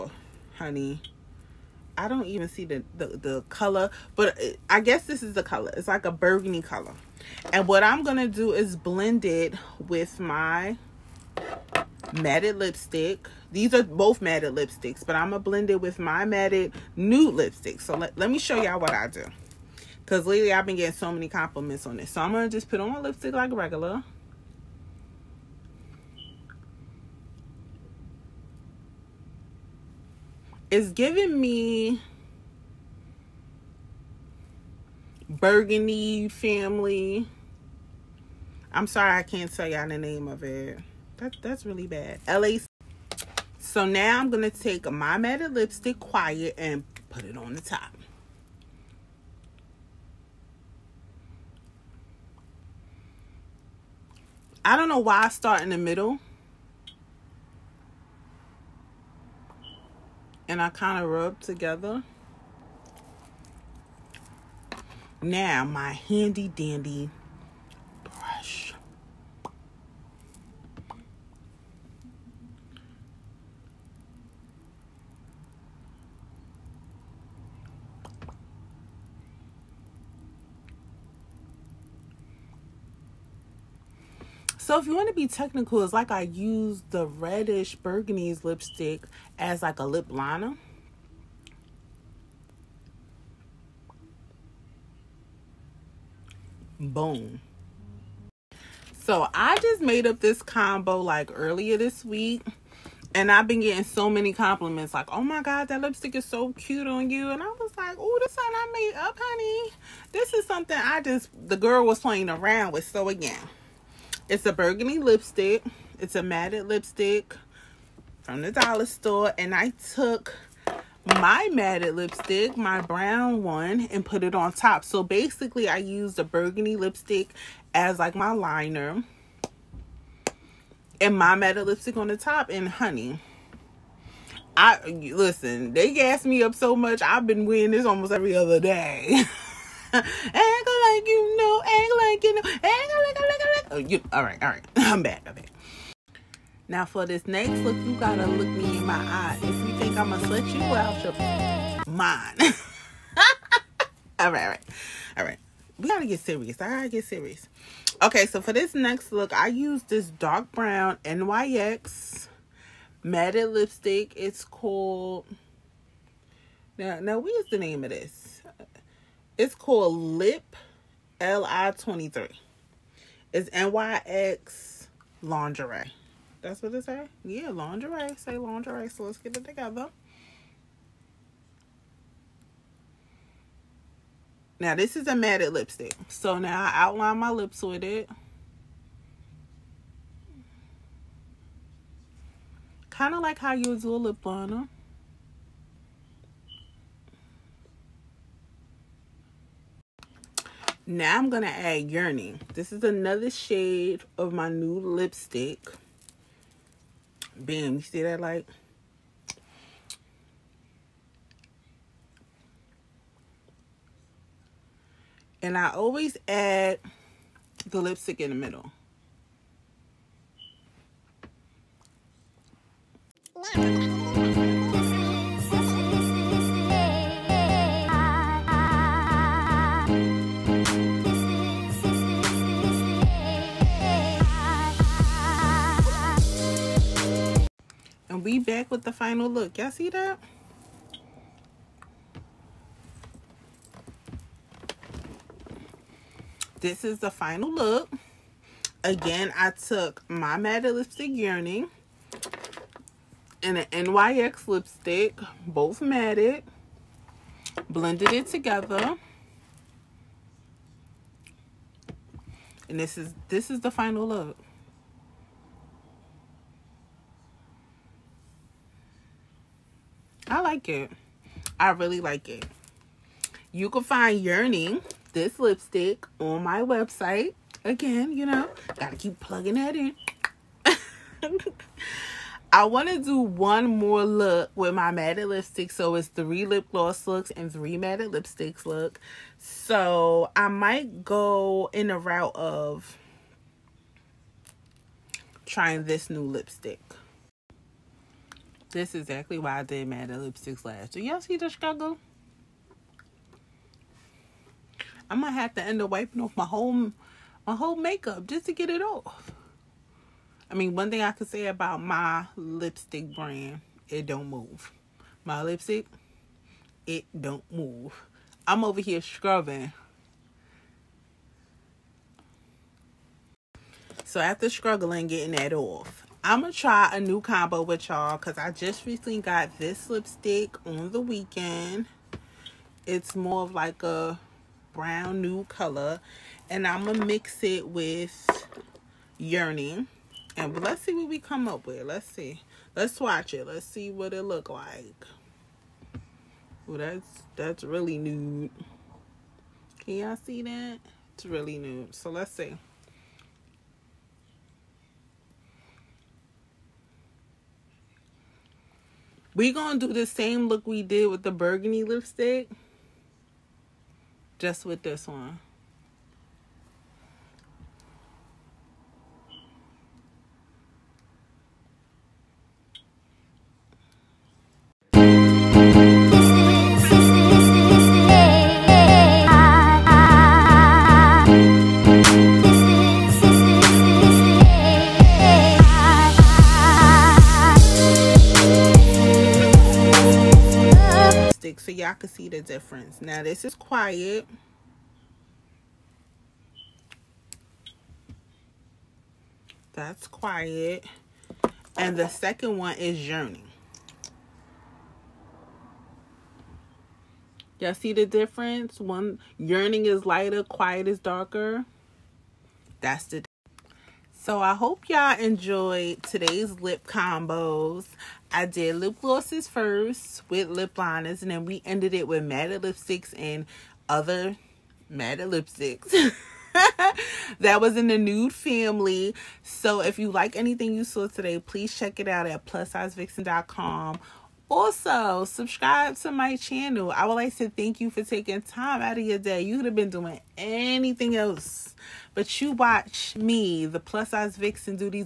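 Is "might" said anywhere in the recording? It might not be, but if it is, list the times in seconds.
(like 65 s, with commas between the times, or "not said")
290 s, 305 s.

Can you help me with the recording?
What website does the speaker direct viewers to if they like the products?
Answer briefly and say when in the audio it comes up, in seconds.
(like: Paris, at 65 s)
plussizevixen.com, at 432 s.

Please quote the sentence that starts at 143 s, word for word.
Oh, you, all right, all right.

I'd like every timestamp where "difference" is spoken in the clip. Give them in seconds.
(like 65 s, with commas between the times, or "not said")
392 s, 408 s.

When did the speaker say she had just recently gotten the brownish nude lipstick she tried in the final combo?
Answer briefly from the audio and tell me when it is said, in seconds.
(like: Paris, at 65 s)
on the weekend, at 330 s.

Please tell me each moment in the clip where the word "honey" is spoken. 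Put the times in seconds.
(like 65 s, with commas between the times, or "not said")
0 s, 109 s, 132 s.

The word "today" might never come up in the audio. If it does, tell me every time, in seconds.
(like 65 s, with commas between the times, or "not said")
416 s, 431 s.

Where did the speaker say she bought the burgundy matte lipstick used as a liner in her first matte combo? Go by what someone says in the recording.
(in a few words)
the dollar store.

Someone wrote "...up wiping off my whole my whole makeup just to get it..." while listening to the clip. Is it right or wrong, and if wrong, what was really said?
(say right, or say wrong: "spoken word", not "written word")
right.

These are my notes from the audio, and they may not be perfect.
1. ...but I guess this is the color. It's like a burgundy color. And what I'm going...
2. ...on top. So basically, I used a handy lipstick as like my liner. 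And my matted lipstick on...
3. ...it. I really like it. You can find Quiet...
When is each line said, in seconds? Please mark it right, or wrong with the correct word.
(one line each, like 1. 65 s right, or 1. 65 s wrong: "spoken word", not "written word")
1. 4 s right
2. 124 s wrong: "burgundy", not "handy"
3. 270 s wrong: "Yearning", not "Quiet".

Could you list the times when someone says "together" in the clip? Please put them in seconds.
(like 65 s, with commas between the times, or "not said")
61 s, 179 s, 258 s.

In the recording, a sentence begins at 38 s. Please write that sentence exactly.
I'm sorry I can't tell y'all the name of it.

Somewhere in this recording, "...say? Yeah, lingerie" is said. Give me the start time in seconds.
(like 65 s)
176 s.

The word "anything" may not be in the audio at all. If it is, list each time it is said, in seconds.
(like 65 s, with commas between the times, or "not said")
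430 s, 440 s.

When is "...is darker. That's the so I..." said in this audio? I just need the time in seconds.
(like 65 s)
410 s.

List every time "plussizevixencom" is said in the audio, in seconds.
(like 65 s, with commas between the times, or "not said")
432 s.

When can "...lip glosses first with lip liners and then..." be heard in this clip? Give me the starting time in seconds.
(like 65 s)
418 s.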